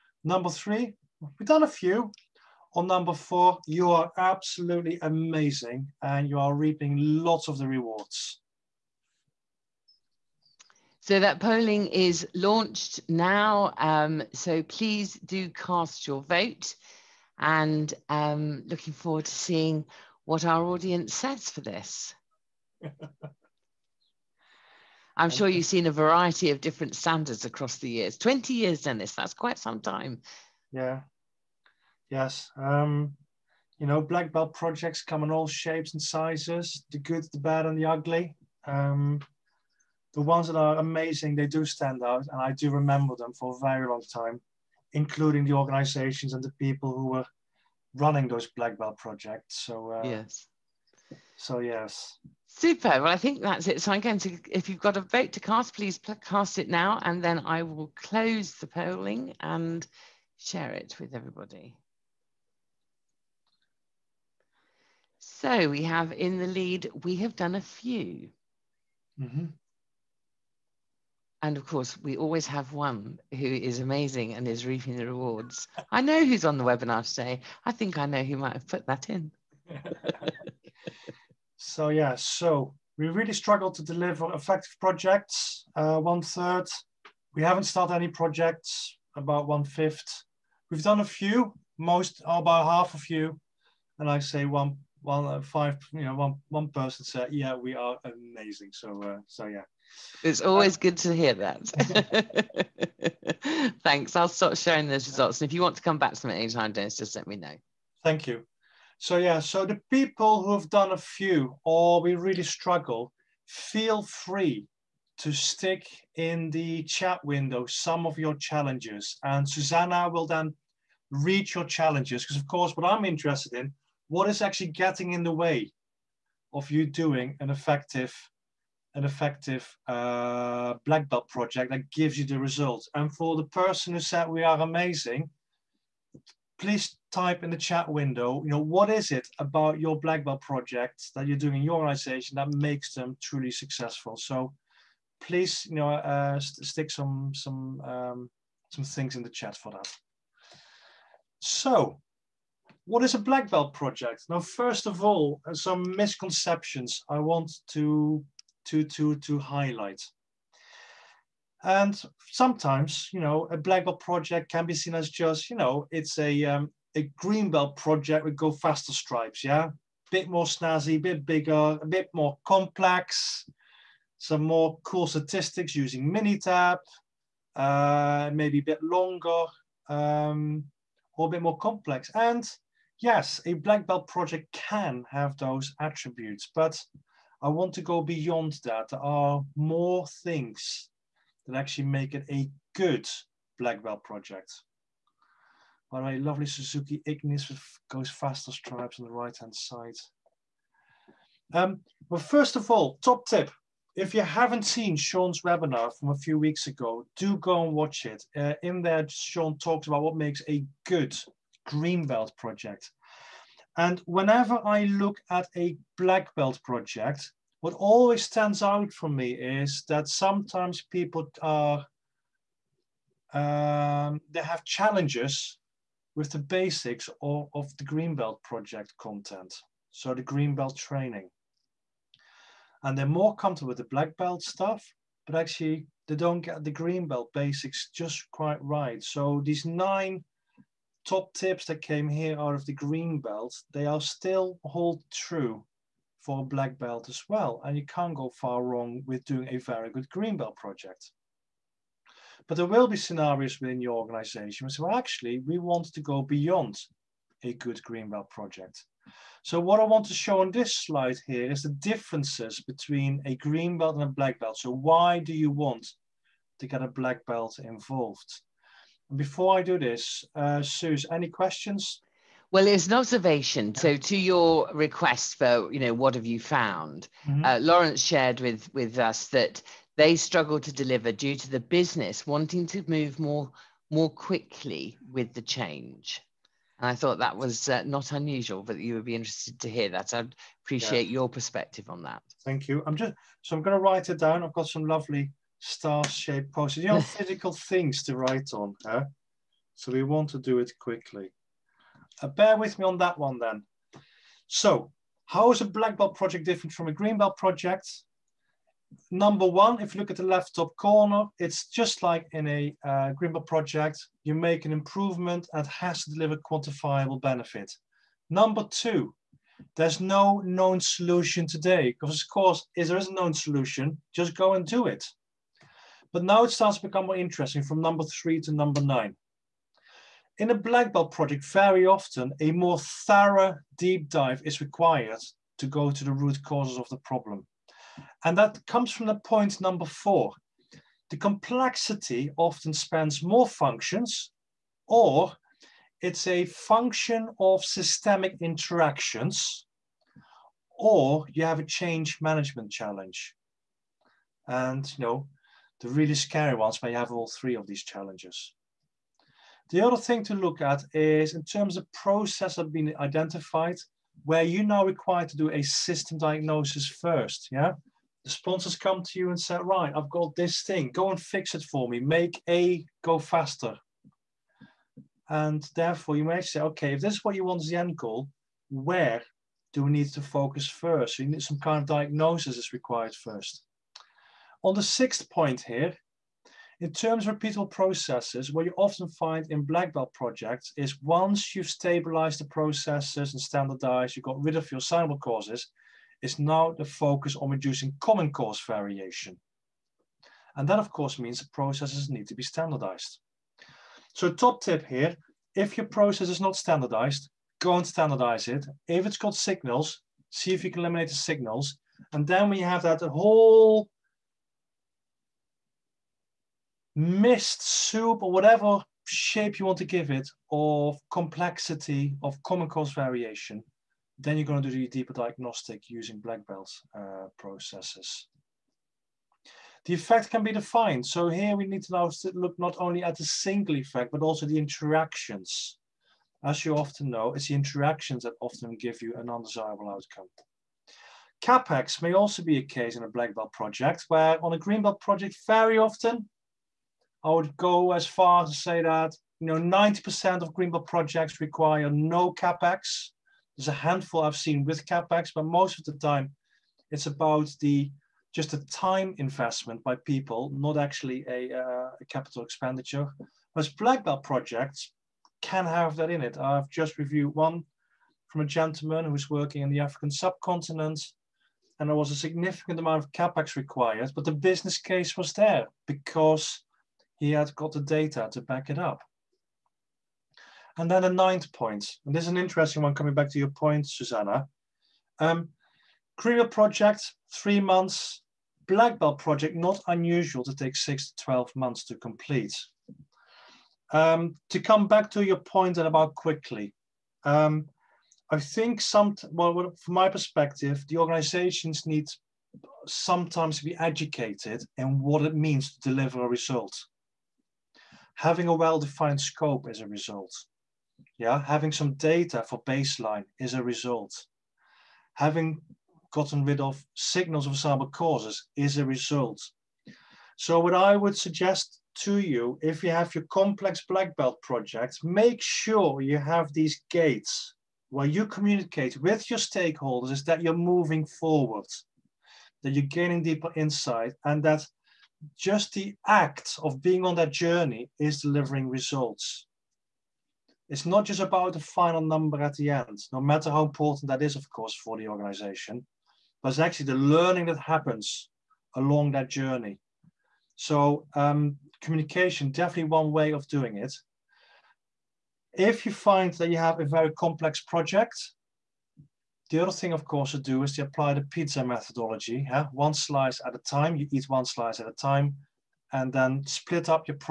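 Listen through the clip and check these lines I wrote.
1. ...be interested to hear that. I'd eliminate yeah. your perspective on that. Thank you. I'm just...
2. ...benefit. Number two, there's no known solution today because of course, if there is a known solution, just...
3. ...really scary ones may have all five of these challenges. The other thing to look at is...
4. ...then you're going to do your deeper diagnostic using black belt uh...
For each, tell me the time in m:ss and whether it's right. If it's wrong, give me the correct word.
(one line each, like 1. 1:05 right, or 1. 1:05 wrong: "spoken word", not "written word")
1. 4:49 wrong: "appreciate", not "eliminate"
2. 5:17 right
3. 5:55 wrong: "three", not "five"
4. 7:04 right.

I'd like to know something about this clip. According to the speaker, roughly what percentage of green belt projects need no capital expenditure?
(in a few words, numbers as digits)
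90%.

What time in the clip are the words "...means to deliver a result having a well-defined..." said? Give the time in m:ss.
8:25.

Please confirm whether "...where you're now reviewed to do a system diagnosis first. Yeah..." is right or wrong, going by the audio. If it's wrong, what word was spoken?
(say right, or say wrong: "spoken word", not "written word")
wrong: "required", not "reviewed".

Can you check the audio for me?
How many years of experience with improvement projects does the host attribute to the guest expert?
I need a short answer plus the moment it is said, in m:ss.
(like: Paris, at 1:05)
20 years, at 0:28.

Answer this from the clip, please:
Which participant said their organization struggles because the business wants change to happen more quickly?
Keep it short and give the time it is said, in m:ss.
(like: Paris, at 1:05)
Lawrence, at 4:37.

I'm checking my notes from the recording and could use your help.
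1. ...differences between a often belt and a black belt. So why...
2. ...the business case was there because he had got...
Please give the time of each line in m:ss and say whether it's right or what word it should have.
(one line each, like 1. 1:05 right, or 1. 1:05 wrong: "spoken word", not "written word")
1. 4:21 wrong: "green", not "often"
2. 7:54 right.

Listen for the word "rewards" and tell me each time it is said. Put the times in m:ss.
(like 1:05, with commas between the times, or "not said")
0:07, 1:15.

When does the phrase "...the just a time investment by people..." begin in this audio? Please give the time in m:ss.
7:37.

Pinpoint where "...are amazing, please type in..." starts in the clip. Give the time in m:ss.
2:14.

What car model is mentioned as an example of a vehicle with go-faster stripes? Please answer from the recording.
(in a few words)
Suzuki Ignis.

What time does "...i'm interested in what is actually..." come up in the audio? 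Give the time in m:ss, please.
2:02.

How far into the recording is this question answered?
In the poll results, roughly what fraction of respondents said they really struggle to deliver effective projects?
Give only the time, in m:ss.
1:26.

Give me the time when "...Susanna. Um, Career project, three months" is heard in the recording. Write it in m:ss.
8:03.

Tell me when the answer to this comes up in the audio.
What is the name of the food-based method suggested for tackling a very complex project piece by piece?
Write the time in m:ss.
9:21.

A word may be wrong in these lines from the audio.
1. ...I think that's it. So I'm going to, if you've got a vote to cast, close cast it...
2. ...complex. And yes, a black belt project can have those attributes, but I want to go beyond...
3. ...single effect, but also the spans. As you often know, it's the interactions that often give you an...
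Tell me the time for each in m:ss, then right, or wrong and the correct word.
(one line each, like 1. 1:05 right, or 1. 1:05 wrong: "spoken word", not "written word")
1. 0:53 wrong: "please", not "close"
2. 3:01 right
3. 7:13 wrong: "interactions", not "spans".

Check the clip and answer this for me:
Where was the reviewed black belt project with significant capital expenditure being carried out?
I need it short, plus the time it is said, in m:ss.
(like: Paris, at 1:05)
African subcontinent, at 7:49.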